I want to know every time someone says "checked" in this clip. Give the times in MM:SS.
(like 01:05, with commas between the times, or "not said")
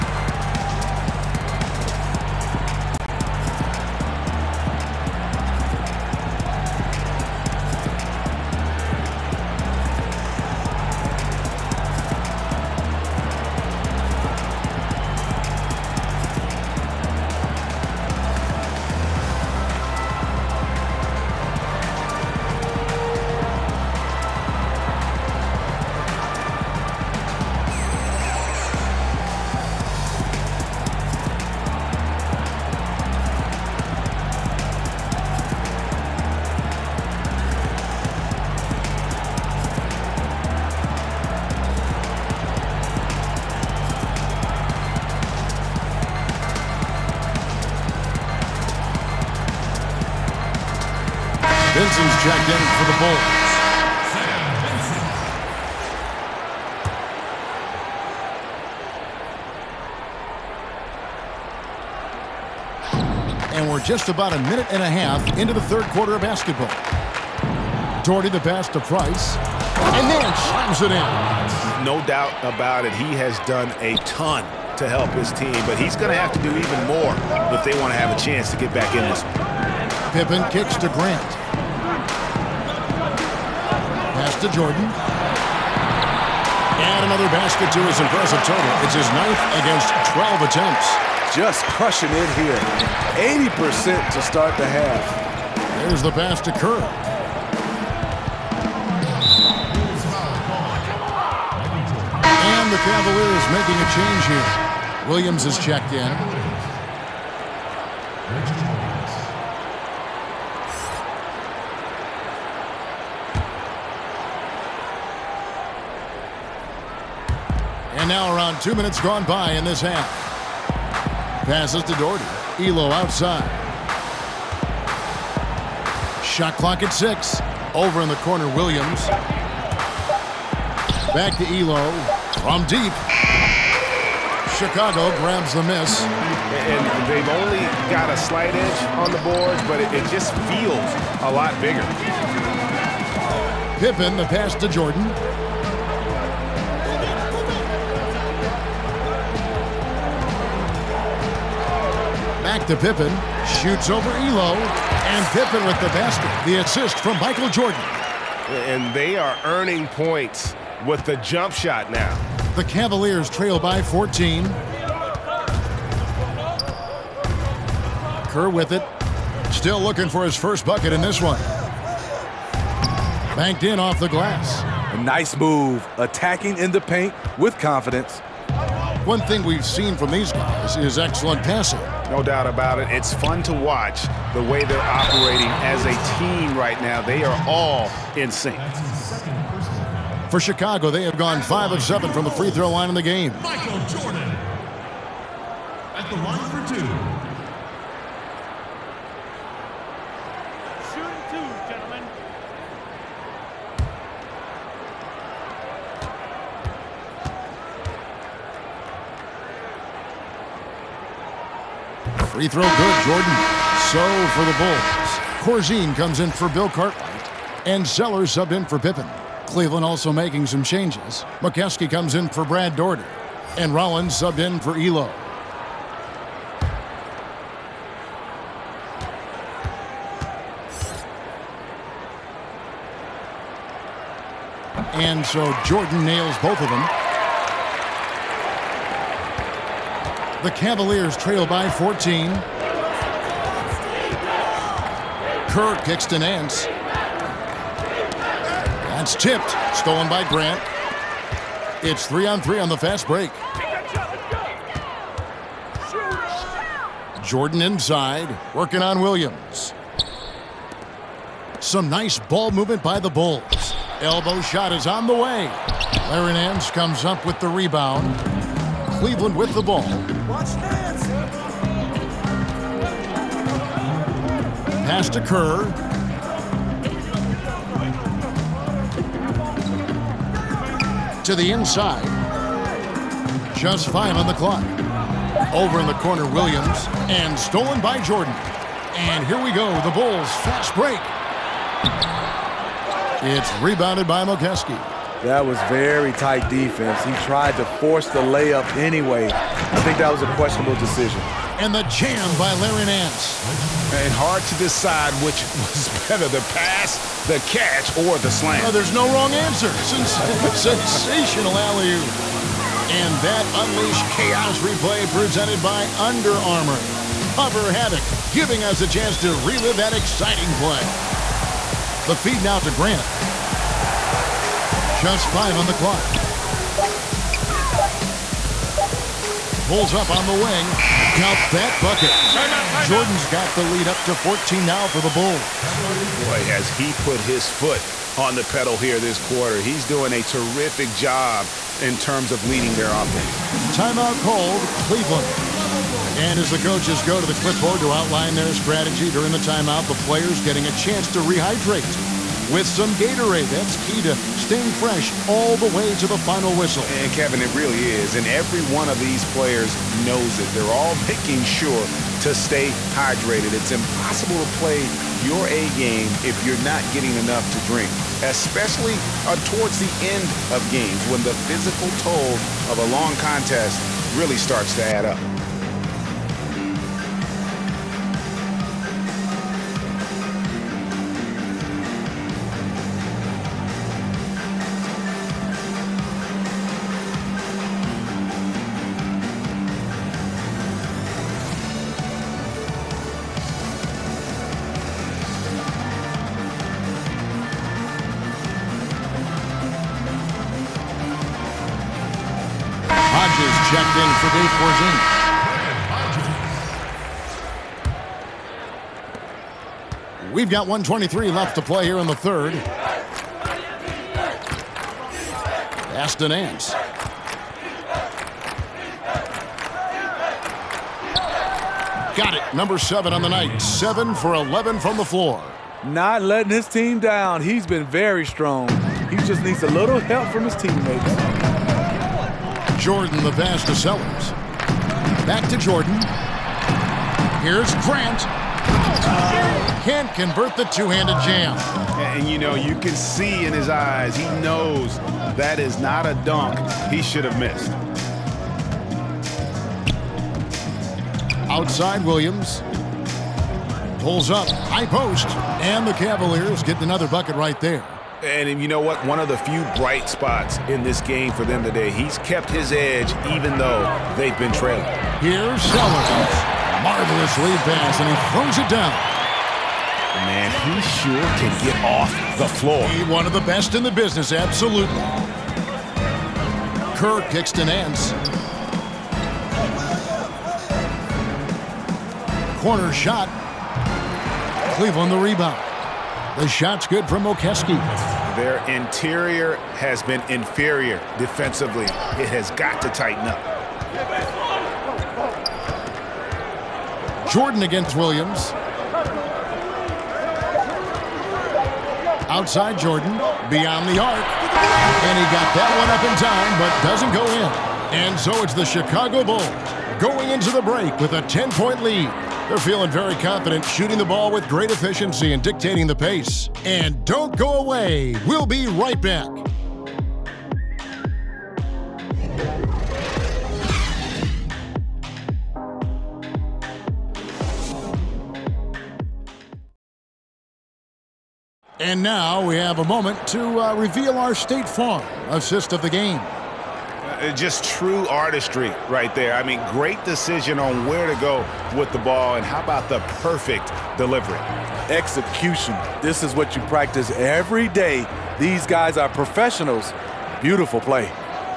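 00:52, 01:45.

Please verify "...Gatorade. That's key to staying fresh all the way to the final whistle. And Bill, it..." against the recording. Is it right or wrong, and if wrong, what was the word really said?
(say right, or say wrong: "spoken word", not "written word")
wrong: "Kevin", not "Bill".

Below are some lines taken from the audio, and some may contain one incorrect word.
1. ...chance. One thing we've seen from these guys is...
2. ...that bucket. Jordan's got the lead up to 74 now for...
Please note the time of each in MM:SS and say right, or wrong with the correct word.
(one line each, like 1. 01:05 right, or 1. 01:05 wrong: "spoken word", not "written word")
1. 02:57 wrong: "confidence", not "chance"
2. 05:31 wrong: "14", not "74".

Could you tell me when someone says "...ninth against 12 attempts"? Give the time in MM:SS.
01:29.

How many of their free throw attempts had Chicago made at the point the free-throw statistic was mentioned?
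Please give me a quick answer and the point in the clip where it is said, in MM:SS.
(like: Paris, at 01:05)
5 of 7, at 03:11.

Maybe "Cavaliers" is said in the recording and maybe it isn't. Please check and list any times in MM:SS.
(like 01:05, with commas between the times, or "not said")
01:42, 02:42, 04:00, 07:35.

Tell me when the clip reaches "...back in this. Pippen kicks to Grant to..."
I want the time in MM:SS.
01:18.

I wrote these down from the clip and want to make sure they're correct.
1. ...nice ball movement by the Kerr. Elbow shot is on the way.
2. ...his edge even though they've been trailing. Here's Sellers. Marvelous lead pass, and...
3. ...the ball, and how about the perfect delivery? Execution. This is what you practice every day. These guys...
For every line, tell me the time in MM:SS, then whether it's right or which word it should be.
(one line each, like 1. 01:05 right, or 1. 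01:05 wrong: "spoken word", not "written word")
1. 04:21 wrong: "Bulls", not "Kerr"
2. 07:42 right
3. 09:01 right.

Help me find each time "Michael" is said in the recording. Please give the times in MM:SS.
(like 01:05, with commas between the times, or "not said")
02:37, 03:13.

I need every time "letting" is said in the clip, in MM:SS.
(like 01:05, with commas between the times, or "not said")
07:06.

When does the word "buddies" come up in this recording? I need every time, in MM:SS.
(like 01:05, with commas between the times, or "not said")
not said.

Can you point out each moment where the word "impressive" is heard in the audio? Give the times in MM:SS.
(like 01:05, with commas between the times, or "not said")
01:28.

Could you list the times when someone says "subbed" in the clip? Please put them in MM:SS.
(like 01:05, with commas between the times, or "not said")
03:38, 03:44.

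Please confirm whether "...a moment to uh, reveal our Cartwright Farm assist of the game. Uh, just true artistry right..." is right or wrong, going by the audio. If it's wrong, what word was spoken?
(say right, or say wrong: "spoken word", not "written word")
wrong: "State", not "Cartwright".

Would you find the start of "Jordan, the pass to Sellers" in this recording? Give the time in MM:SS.
07:12.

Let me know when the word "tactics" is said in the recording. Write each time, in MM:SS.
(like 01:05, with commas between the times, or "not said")
not said.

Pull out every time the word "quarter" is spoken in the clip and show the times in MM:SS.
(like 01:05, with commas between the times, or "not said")
01:05, 05:39.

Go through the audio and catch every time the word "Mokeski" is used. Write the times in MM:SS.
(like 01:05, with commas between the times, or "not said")
03:41, 04:54, 08:07.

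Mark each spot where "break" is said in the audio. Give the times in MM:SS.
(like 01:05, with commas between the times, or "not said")
04:13, 04:50, 08:30.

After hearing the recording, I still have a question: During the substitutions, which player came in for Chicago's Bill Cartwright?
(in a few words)
Corzine.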